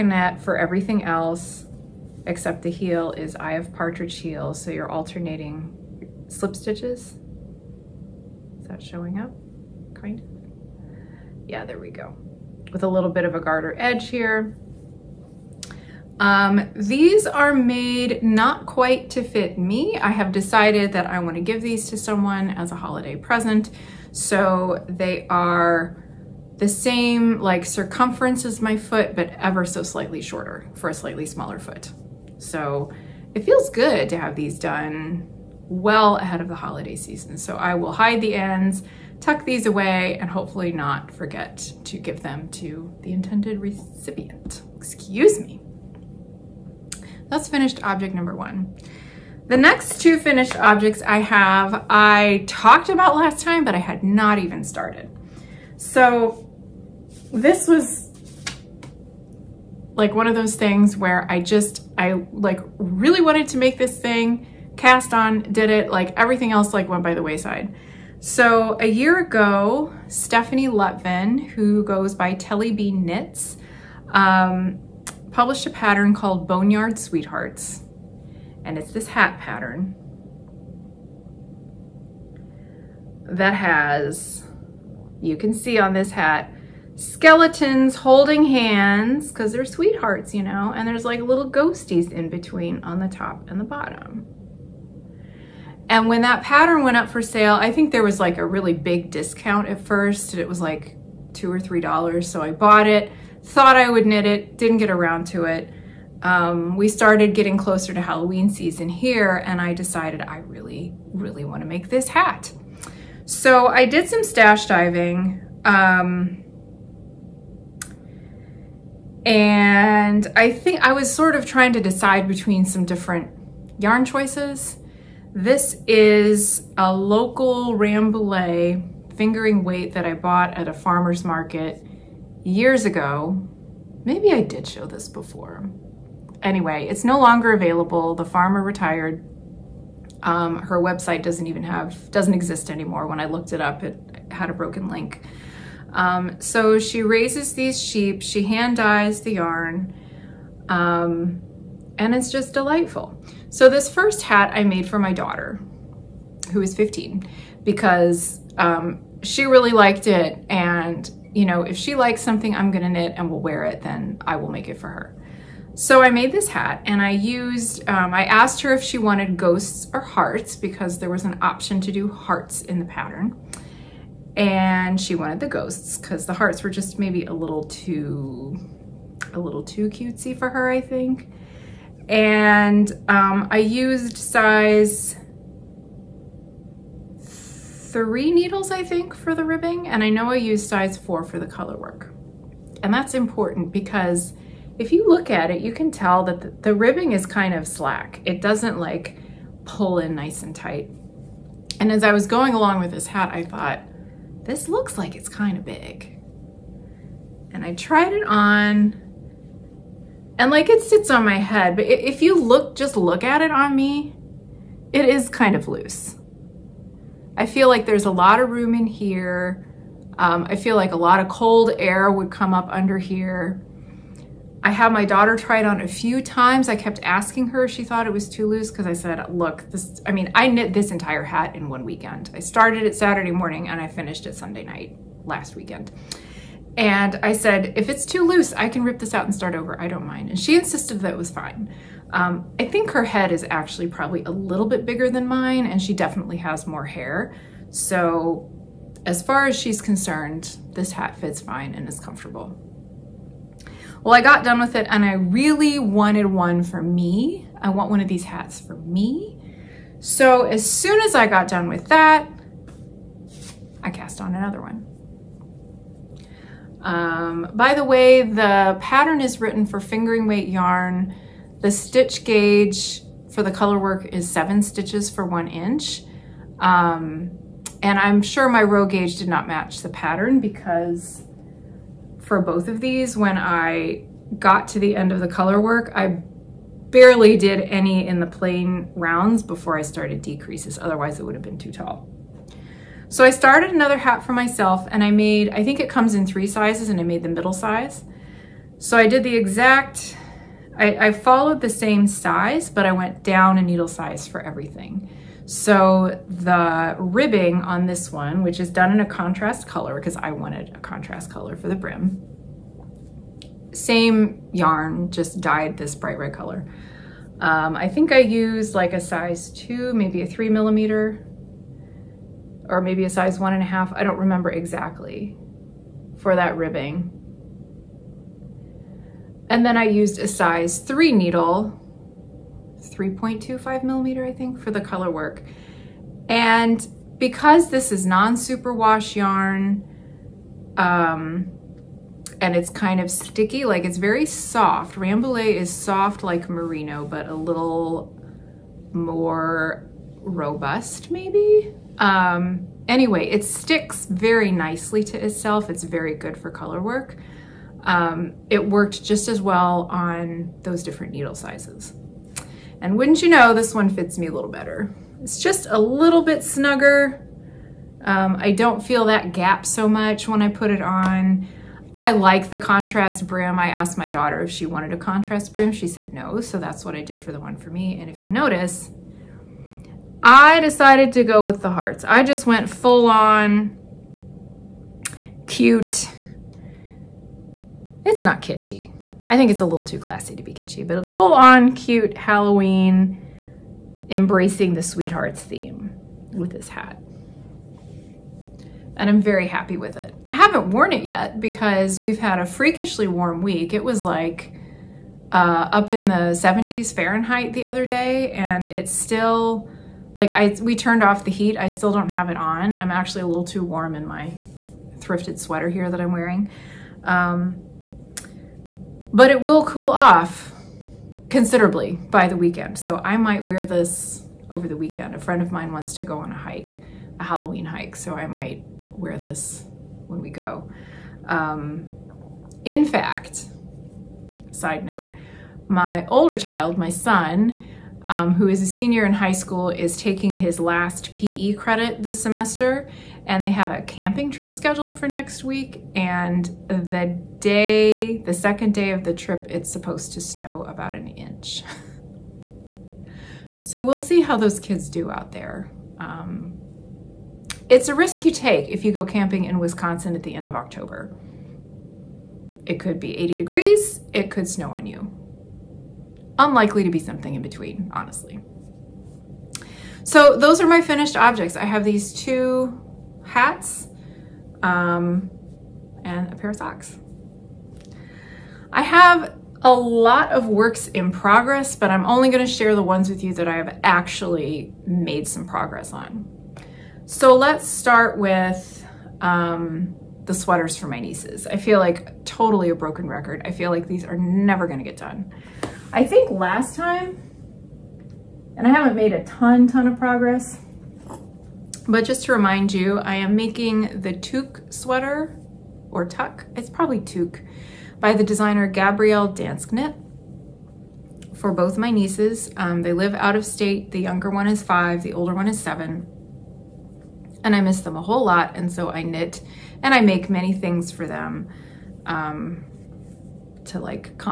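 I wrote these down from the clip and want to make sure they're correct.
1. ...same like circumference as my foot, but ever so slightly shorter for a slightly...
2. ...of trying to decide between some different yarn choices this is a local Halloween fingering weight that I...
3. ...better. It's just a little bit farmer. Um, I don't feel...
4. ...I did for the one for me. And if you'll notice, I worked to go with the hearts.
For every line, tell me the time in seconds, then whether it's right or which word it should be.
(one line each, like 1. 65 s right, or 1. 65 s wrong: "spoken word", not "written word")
1. 26 s right
2. 121 s wrong: "Rambouillet", not "Halloween"
3. 364 s wrong: "snugger", not "farmer"
4. 376 s wrong: "decided", not "worked".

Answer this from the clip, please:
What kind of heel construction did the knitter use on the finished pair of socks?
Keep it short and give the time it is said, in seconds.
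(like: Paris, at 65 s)
Eye of partridge heel, at 3 s.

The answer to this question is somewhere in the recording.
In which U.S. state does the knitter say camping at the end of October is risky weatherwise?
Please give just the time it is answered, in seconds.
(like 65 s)
459 s.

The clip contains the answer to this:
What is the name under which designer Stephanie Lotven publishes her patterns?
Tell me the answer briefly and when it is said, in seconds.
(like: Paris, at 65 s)
Tellybean Knits, at 72 s.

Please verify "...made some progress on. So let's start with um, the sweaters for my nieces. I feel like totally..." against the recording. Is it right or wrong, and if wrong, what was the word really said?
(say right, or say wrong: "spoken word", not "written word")
right.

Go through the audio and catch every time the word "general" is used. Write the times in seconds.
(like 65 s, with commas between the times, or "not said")
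not said.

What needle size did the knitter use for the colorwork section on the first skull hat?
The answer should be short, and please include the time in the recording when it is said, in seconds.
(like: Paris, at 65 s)
Size 4, at 190 s.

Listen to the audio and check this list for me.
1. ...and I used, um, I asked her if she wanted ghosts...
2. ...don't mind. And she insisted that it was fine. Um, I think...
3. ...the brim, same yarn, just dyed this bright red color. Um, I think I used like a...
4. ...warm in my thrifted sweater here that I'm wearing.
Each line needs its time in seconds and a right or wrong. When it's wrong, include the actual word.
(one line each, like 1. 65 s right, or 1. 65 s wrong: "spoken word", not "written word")
1. 166 s right
2. 239 s right
3. 311 s right
4. 413 s right.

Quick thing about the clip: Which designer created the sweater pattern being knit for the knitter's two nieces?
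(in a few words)
Gabrielle Dansknit.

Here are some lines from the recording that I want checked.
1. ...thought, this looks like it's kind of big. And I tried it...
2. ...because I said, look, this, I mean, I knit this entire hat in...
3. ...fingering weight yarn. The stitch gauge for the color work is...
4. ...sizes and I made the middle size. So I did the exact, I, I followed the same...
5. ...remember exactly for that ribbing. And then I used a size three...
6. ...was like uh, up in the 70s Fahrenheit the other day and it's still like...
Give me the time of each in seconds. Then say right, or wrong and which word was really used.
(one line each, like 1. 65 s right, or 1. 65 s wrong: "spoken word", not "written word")
1. 203 s right
2. 228 s right
3. 269 s right
4. 296 s right
5. 324 s right
6. 403 s right.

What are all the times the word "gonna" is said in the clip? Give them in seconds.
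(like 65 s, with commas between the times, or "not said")
162 s, 482 s, 494 s.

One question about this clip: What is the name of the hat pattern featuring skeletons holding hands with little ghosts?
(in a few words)
Boneyard Sweethearts.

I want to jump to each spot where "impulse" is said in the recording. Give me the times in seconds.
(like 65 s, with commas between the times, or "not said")
not said.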